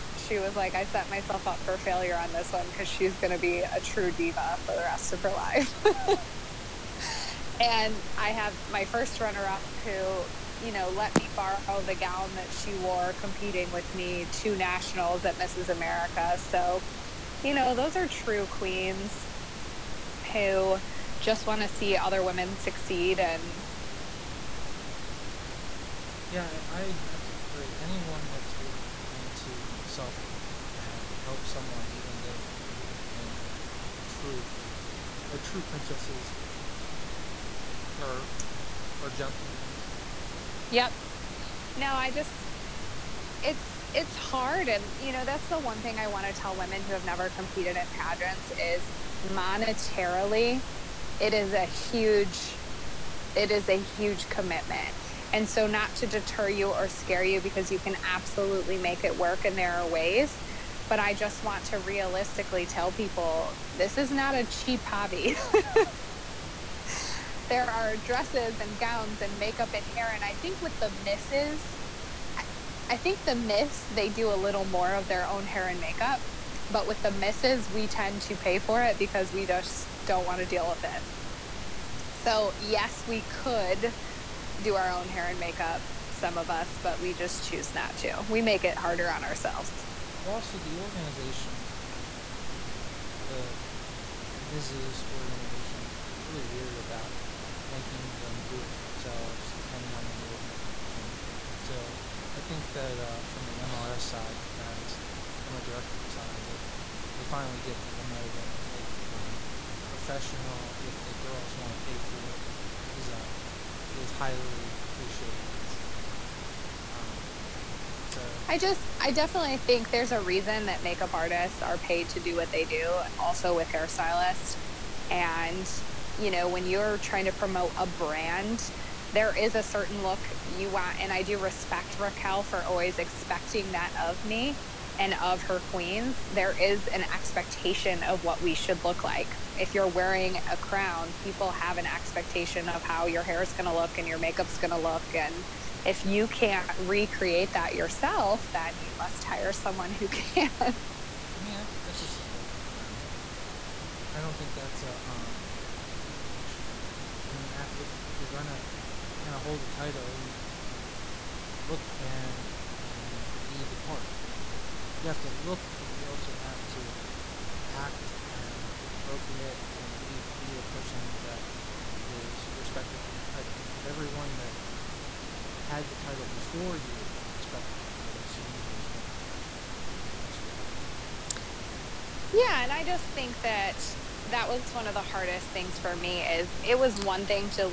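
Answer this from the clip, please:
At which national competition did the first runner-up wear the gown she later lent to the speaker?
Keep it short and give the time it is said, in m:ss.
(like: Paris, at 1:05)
Mrs. America, at 0:15.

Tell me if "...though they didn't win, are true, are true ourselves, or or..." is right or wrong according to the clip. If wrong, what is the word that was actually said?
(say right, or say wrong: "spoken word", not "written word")
wrong: "princesses", not "ourselves".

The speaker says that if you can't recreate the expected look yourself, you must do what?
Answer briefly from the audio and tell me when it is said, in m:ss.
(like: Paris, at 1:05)
Hire someone, at 2:29.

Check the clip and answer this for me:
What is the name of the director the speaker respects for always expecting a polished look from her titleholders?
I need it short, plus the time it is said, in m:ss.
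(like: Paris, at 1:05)
Raquel, at 2:11.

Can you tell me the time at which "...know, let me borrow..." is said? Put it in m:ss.
0:10.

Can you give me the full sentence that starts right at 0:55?
And so not to deter you or scare you because you can absolutely make it work and there are ways.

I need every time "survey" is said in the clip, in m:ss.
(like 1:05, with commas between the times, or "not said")
not said.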